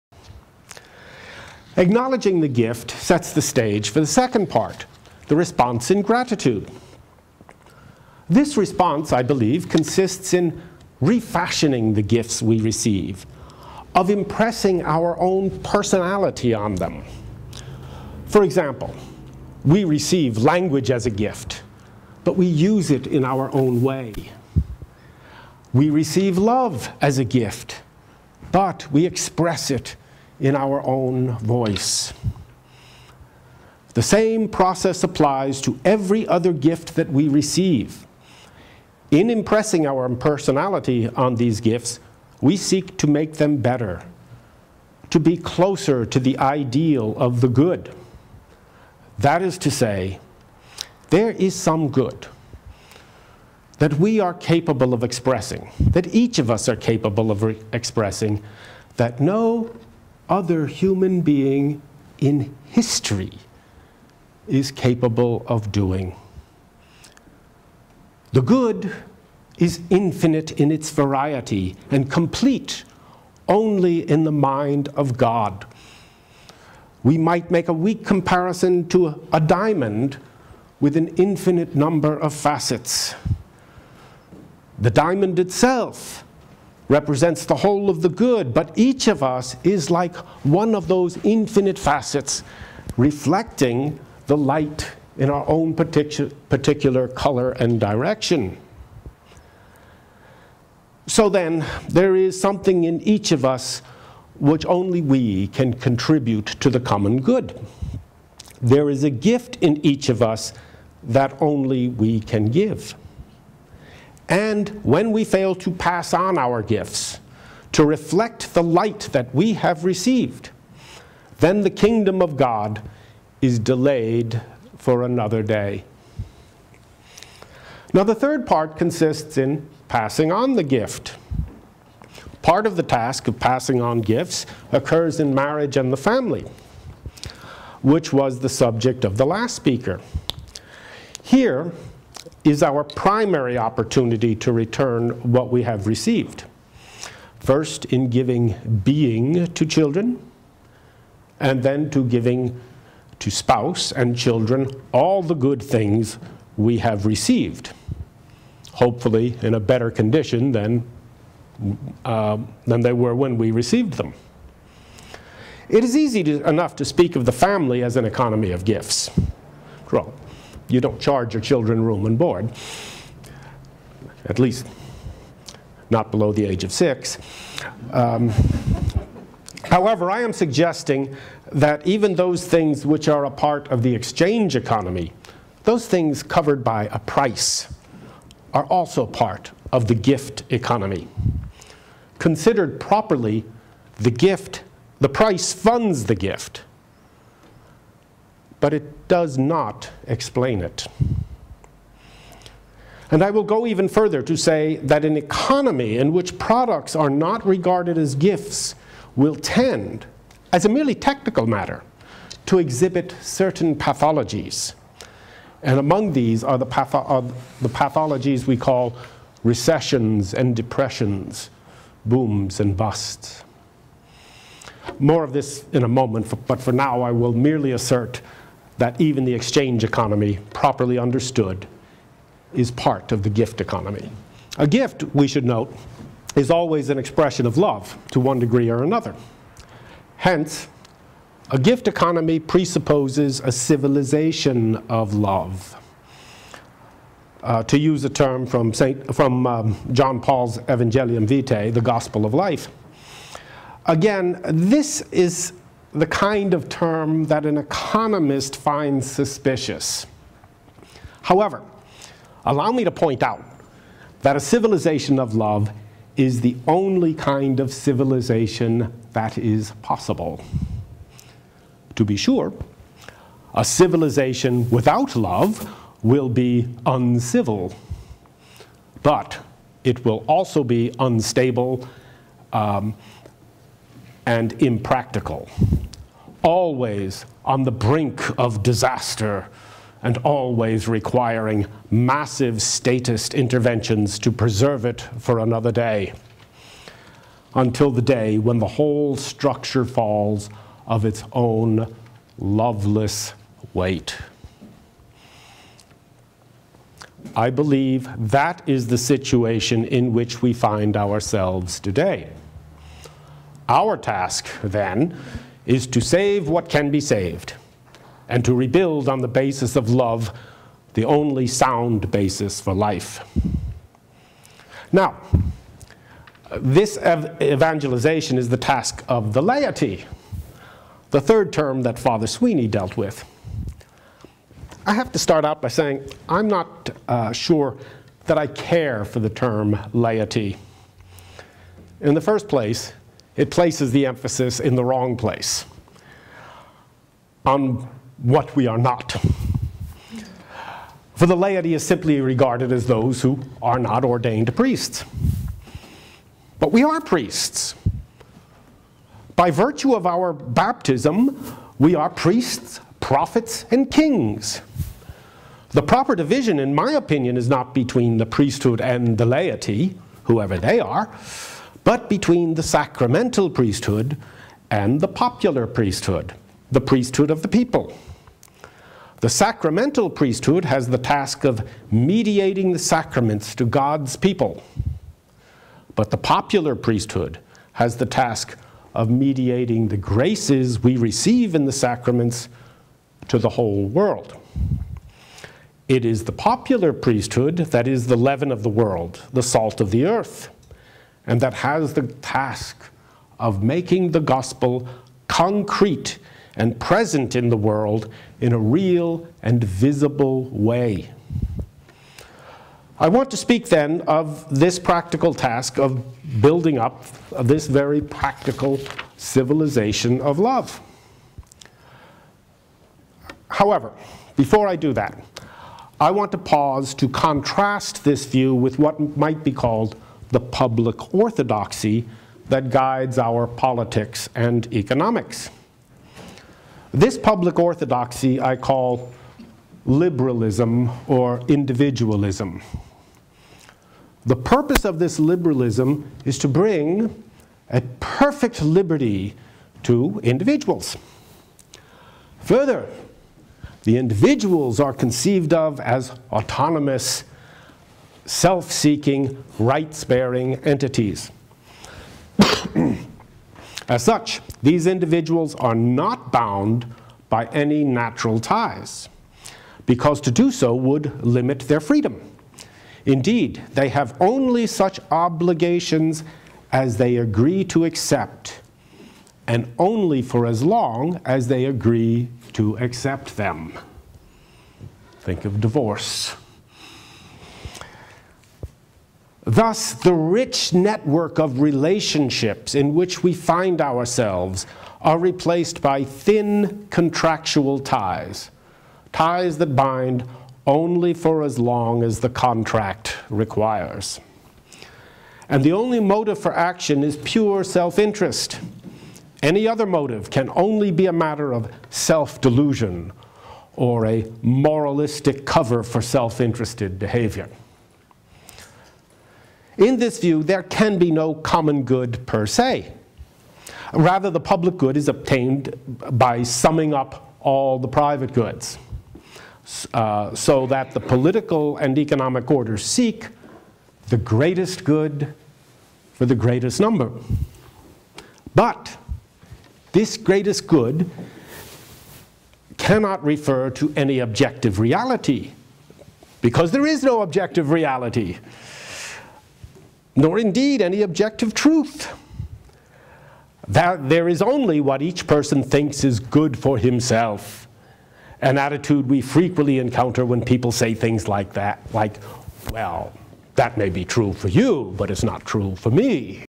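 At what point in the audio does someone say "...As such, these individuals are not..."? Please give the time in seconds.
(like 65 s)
463 s.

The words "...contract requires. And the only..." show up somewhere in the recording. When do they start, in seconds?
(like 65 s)
502 s.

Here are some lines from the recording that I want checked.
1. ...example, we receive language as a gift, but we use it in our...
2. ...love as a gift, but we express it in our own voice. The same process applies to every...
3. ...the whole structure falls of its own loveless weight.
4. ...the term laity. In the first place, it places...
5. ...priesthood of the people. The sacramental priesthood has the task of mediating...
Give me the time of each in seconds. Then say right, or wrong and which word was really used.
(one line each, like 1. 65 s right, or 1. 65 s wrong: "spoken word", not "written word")
1. 18 s right
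2. 26 s right
3. 298 s right
4. 339 s right
5. 376 s right.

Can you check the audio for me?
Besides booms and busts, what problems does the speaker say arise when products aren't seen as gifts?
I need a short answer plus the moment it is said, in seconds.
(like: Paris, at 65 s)
recessions and depressions, at 219 s.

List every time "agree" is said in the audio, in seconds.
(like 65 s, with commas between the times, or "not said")
477 s, 481 s.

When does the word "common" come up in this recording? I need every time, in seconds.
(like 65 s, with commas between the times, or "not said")
106 s, 521 s.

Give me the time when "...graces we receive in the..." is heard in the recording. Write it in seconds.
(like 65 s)
389 s.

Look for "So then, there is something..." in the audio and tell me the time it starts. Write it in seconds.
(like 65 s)
101 s.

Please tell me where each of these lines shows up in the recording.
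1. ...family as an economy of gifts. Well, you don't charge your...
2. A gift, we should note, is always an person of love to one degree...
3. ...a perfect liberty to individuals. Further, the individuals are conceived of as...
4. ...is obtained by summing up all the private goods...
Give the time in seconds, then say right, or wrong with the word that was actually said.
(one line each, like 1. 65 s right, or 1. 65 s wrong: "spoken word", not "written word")
1. 167 s right
2. 234 s wrong: "expression", not "person"
3. 447 s right
4. 524 s right.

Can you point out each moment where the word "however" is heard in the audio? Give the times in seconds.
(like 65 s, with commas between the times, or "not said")
179 s, 261 s, 423 s.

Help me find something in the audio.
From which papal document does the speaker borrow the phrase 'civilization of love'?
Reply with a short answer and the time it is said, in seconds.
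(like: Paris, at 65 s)
Evangelium Vitae, at 250 s.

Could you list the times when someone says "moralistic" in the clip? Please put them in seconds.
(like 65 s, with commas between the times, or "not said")
514 s.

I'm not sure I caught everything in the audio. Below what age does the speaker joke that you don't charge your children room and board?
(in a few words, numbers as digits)
6.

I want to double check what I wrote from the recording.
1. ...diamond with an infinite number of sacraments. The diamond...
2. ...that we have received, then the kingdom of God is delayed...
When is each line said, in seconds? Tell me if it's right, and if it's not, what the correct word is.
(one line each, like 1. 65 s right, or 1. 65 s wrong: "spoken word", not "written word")
1. 79 s wrong: "facets", not "sacraments"
2. 119 s right.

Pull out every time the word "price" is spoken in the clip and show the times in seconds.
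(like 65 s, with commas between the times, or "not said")
186 s, 195 s.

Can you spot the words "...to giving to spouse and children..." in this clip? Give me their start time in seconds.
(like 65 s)
151 s.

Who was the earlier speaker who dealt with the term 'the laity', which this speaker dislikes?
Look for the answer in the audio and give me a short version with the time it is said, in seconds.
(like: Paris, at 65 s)
Father Sweeney, at 331 s.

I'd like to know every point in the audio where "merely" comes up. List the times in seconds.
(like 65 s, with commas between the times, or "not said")
210 s, 227 s.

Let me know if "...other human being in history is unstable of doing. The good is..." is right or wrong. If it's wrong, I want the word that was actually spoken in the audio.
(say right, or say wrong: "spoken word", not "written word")
wrong: "capable", not "unstable".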